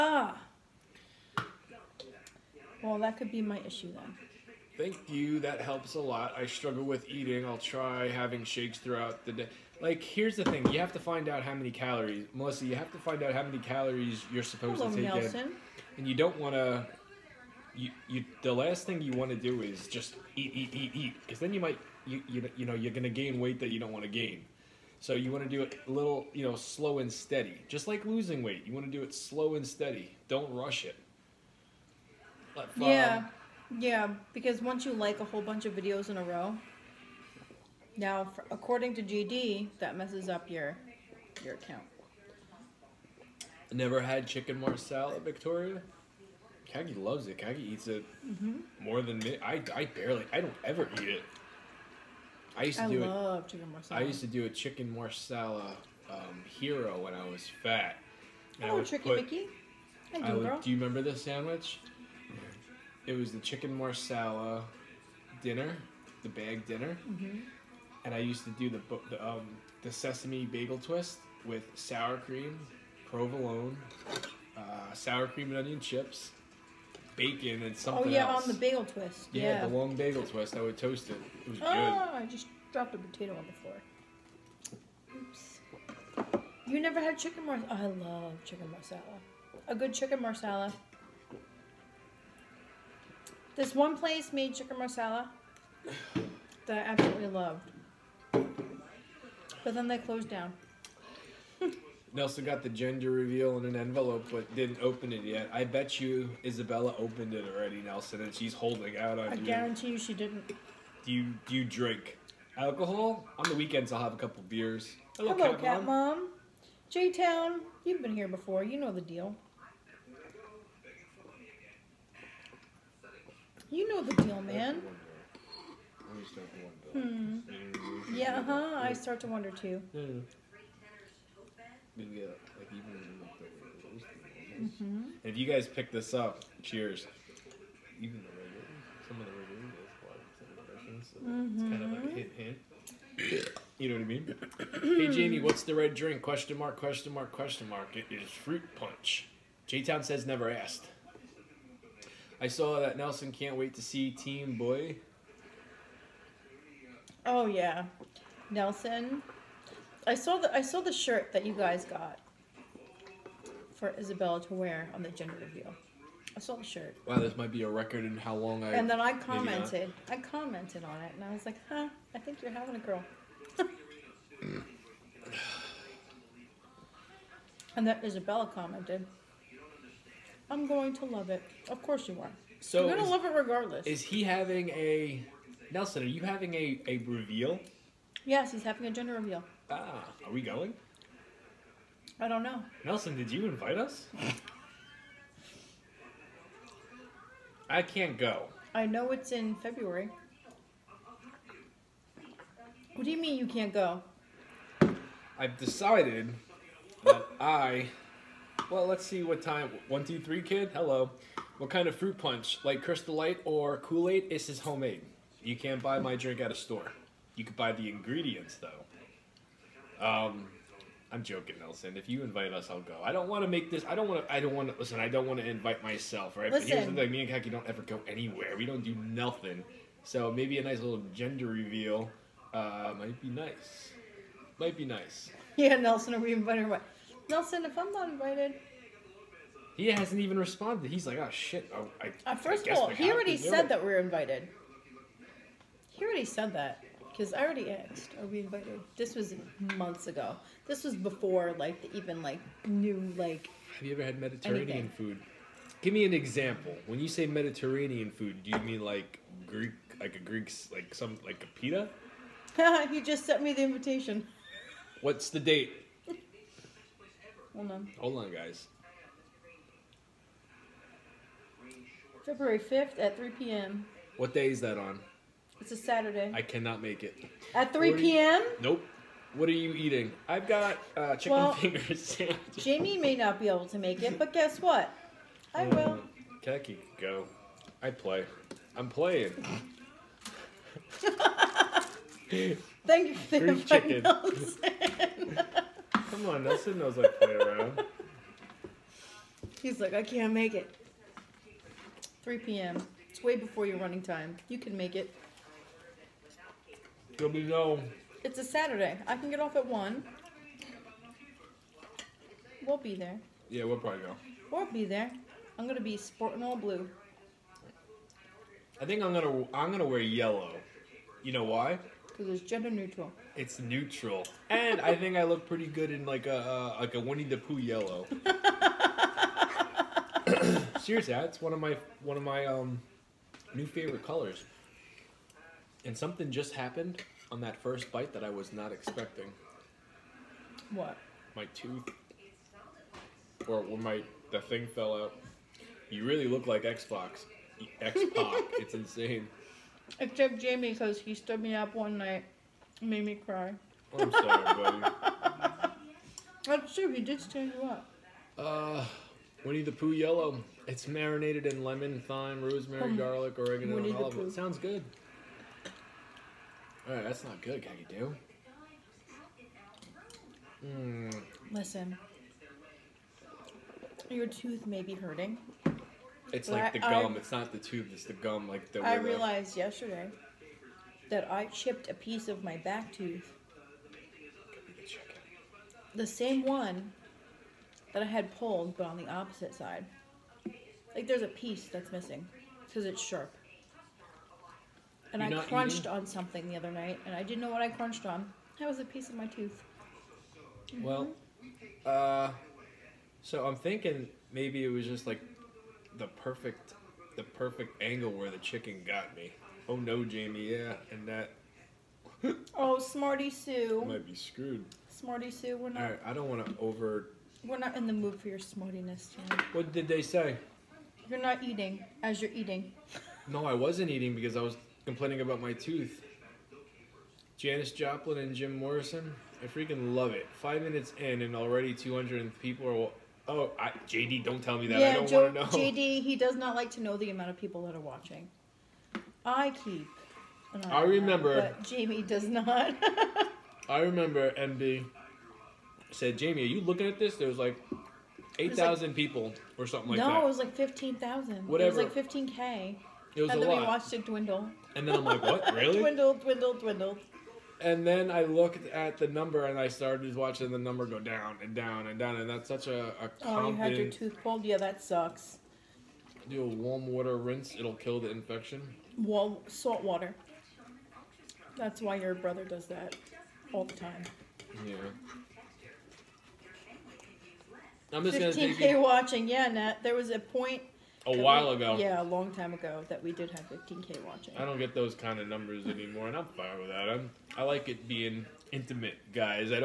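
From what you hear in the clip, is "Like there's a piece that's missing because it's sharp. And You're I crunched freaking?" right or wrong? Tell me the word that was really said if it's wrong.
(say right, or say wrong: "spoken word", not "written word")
wrong: "eating", not "freaking".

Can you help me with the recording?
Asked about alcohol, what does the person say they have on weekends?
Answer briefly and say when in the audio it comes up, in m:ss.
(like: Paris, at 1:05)
a couple beers, at 1:54.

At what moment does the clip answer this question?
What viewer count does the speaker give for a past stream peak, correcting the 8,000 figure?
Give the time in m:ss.
7:30.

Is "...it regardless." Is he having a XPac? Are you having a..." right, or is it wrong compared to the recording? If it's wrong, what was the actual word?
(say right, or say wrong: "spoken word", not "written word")
wrong: "Nelson", not "XPac".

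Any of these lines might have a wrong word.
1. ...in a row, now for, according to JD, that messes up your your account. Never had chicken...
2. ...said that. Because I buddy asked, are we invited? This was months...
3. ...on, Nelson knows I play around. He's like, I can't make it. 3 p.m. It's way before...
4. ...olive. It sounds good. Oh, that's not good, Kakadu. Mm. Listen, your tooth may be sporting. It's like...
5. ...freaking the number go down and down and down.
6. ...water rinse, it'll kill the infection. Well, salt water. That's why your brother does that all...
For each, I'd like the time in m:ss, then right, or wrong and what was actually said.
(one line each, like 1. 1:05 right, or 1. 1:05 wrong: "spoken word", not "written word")
1. 0:36 right
2. 4:06 wrong: "already", not "buddy"
3. 4:56 right
4. 6:03 wrong: "hurting", not "sporting"
5. 7:40 wrong: "watching", not "freaking"
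6. 7:46 right.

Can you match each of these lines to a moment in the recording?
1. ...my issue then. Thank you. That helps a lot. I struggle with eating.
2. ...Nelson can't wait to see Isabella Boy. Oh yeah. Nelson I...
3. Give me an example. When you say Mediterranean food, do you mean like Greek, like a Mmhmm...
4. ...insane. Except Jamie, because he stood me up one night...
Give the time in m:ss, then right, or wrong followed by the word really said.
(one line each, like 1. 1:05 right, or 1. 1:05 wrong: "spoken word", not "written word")
1. 0:03 right
2. 2:32 wrong: "Team", not "Isabella"
3. 4:15 wrong: "Greek", not "Mmhmm"
4. 5:48 right.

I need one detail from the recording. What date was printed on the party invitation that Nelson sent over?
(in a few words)
February 5th.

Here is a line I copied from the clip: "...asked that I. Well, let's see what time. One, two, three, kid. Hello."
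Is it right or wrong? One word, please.
wrong.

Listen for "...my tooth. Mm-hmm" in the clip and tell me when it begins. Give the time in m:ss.
6:39.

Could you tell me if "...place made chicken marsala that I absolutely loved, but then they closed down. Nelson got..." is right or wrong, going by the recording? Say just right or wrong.
right.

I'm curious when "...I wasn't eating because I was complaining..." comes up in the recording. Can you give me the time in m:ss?
7:03.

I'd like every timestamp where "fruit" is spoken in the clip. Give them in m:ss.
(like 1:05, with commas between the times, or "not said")
2:28, 3:31.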